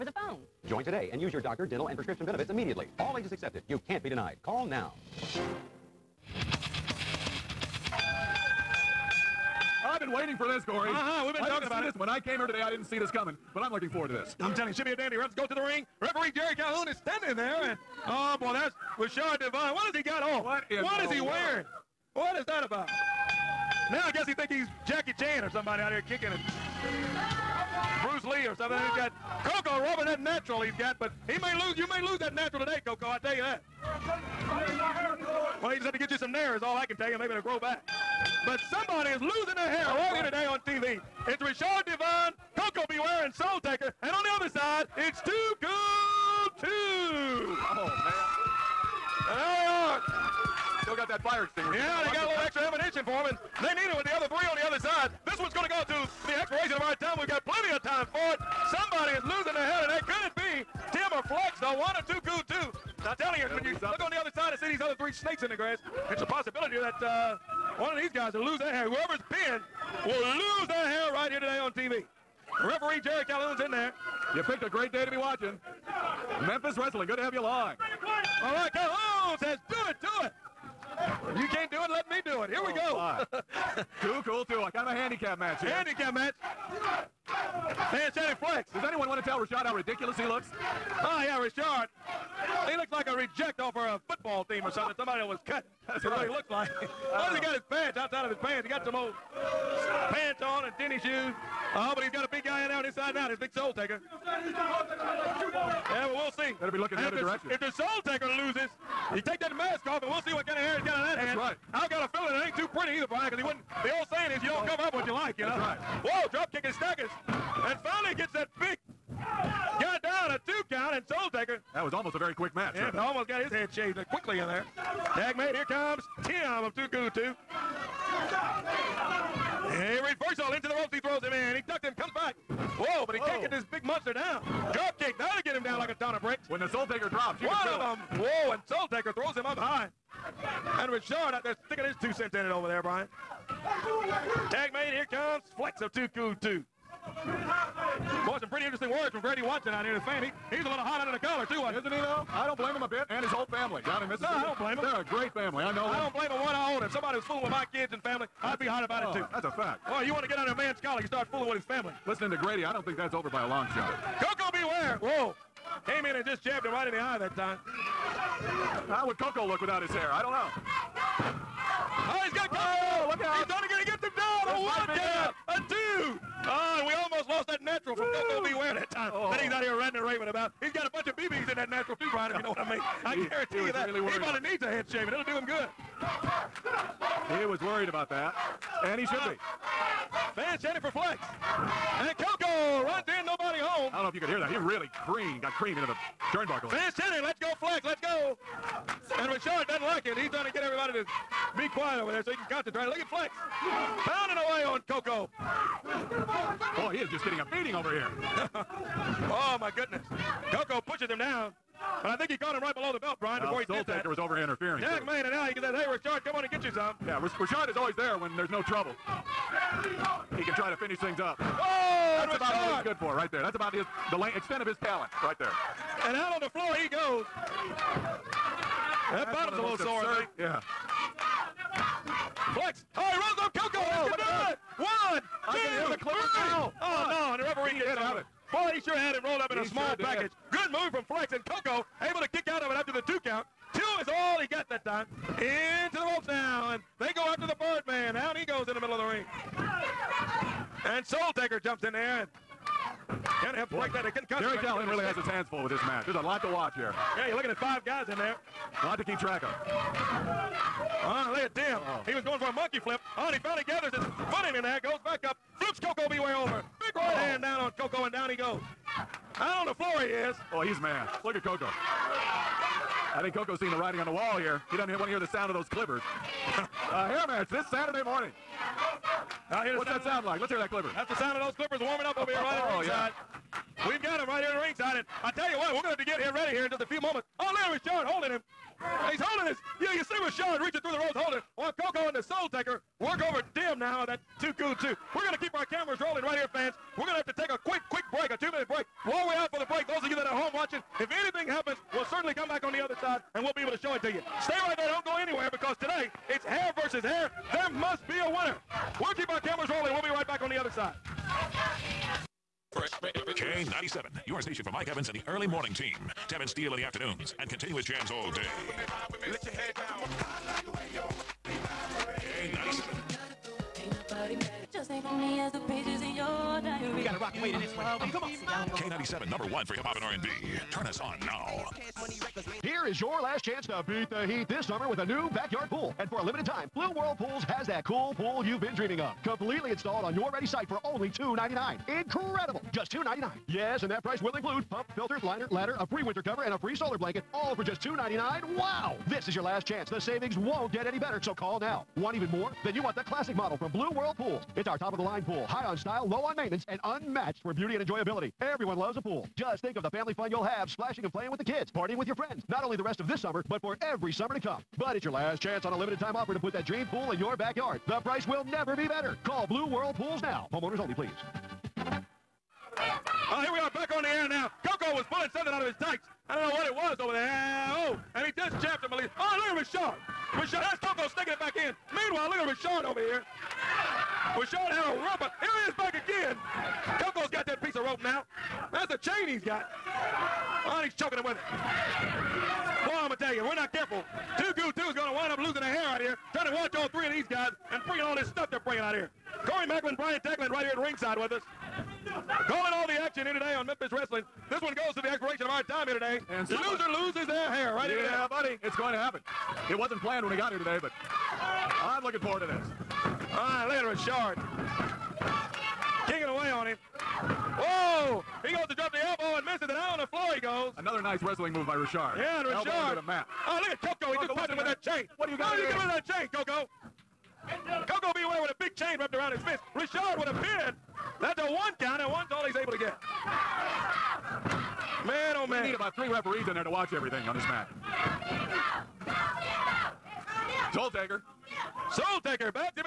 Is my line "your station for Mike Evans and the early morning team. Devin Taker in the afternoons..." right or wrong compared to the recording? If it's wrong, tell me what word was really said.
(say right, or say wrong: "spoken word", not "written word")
wrong: "Steele", not "Taker".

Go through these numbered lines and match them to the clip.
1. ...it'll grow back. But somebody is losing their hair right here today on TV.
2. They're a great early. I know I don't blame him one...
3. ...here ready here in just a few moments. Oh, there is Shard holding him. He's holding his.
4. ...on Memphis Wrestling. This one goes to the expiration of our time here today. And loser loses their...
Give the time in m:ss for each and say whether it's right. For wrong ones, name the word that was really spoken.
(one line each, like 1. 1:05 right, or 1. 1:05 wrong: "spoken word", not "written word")
1. 0:37 right
2. 2:34 wrong: "family", not "early"
3. 4:46 right
4. 6:43 right.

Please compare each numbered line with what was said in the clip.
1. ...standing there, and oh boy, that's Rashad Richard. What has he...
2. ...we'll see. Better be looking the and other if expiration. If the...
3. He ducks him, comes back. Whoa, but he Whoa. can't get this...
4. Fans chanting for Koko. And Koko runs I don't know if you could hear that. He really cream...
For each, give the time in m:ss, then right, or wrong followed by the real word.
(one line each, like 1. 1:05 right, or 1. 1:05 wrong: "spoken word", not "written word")
1. 0:17 wrong: "Devine", not "Richard"
2. 1:46 wrong: "direction", not "expiration"
3. 2:11 right
4. 3:10 wrong: "Flex", not "Koko".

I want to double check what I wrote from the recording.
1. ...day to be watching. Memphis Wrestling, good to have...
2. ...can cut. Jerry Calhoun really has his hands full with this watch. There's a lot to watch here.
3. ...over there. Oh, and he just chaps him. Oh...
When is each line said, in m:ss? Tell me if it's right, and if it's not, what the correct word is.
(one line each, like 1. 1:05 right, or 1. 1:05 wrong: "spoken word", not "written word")
1. 1:14 right
2. 4:14 wrong: "match", not "watch"
3. 6:16 right.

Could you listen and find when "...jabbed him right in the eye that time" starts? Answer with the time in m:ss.
2:46.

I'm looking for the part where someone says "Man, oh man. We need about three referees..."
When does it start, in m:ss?
7:15.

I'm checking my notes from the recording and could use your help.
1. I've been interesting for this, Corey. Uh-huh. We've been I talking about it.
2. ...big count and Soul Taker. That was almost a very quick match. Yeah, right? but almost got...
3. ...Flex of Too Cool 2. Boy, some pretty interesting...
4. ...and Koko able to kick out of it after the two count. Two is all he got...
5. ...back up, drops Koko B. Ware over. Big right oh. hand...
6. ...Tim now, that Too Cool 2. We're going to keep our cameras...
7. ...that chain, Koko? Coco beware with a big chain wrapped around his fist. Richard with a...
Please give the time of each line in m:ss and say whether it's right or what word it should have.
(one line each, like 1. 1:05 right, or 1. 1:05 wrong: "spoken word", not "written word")
1. 0:09 wrong: "waiting", not "interesting"
2. 1:58 right
3. 2:25 right
4. 4:01 right
5. 4:25 wrong: "flips", not "drops"
6. 4:53 right
7. 7:05 right.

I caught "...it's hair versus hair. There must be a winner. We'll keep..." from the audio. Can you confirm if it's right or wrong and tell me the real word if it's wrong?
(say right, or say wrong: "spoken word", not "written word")
right.